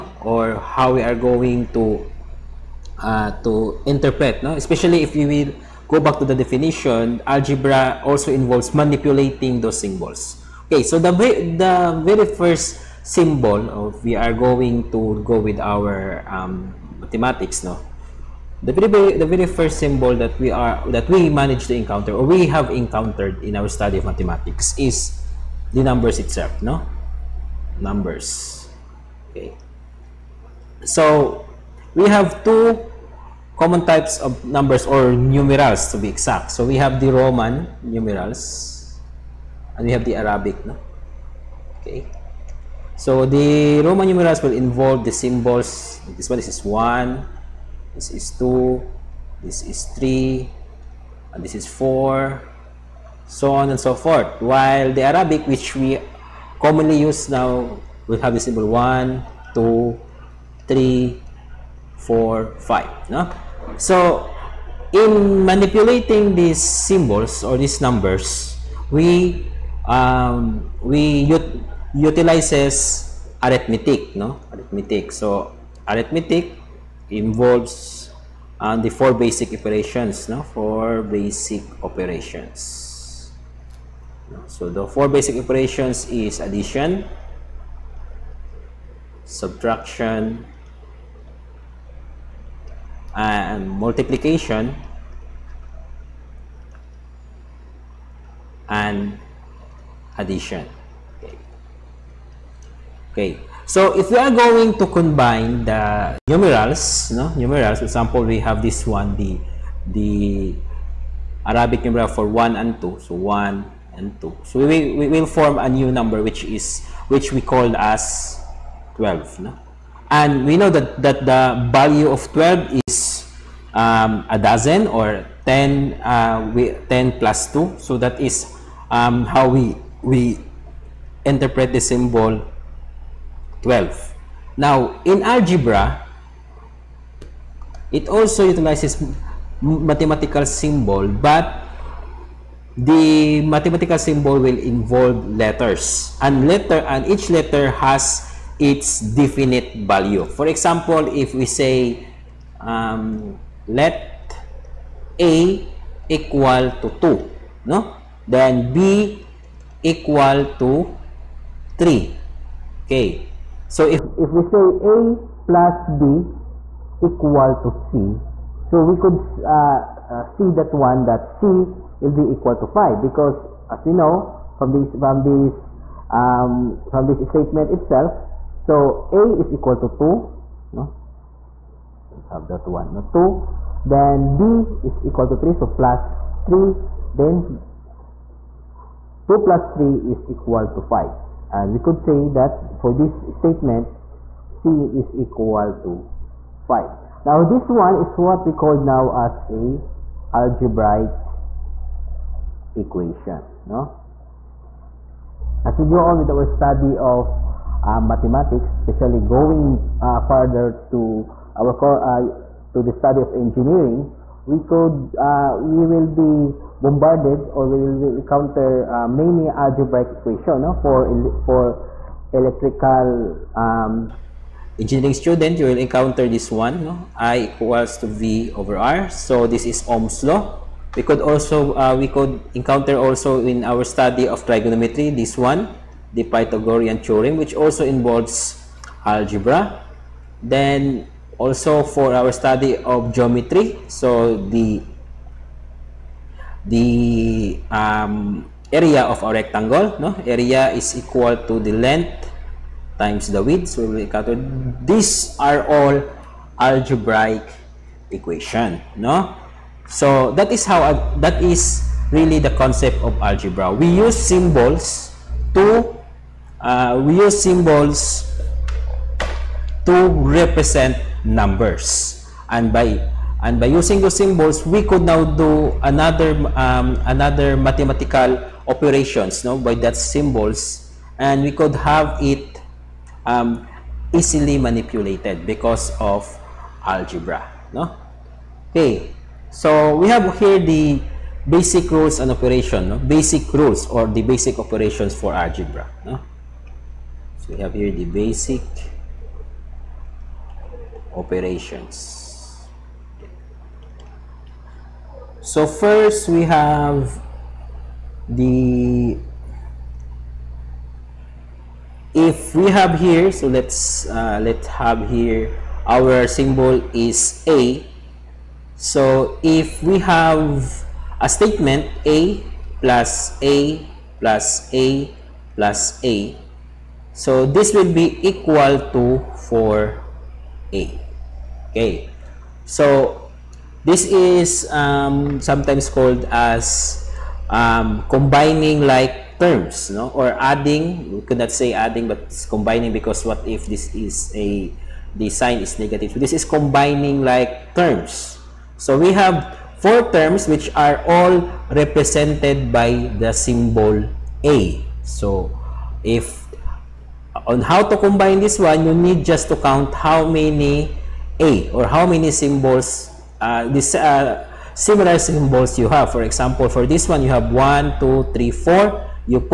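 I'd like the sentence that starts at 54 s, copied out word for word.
While the Arabic, which we commonly use now, will have the symbol 1, 2, 3, 4, 5.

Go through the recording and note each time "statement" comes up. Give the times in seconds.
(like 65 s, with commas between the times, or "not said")
177 s, 193 s, 321 s.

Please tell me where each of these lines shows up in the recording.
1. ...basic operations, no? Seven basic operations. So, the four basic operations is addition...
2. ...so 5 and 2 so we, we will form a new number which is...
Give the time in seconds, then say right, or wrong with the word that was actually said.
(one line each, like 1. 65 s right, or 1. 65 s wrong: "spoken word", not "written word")
1. 79 s wrong: "Four", not "Seven"
2. 112 s wrong: "1", not "5".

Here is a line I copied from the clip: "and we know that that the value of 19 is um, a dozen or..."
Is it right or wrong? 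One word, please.
wrong.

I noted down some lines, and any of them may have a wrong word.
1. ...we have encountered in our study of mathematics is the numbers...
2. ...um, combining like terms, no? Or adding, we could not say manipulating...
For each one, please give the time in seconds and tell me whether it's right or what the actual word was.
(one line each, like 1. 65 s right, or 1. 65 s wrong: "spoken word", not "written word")
1. 22 s right
2. 337 s wrong: "adding", not "manipulating".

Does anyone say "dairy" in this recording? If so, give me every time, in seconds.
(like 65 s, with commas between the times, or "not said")
not said.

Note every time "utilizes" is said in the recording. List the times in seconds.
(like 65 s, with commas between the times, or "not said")
71 s, 138 s.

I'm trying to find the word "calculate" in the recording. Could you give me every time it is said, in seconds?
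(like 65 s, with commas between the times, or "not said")
254 s.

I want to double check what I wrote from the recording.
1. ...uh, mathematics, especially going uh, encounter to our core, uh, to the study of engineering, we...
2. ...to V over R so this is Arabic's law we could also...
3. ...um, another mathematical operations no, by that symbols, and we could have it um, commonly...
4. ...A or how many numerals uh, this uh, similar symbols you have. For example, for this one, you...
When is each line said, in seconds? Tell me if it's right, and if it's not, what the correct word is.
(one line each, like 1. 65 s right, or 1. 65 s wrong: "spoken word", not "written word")
1. 207 s wrong: "further", not "encounter"
2. 228 s wrong: "Ohm", not "Arabic"
3. 276 s wrong: "easily", not "commonly"
4. 361 s wrong: "symbols", not "numerals".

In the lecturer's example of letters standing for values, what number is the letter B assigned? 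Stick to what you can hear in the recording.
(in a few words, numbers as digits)
3.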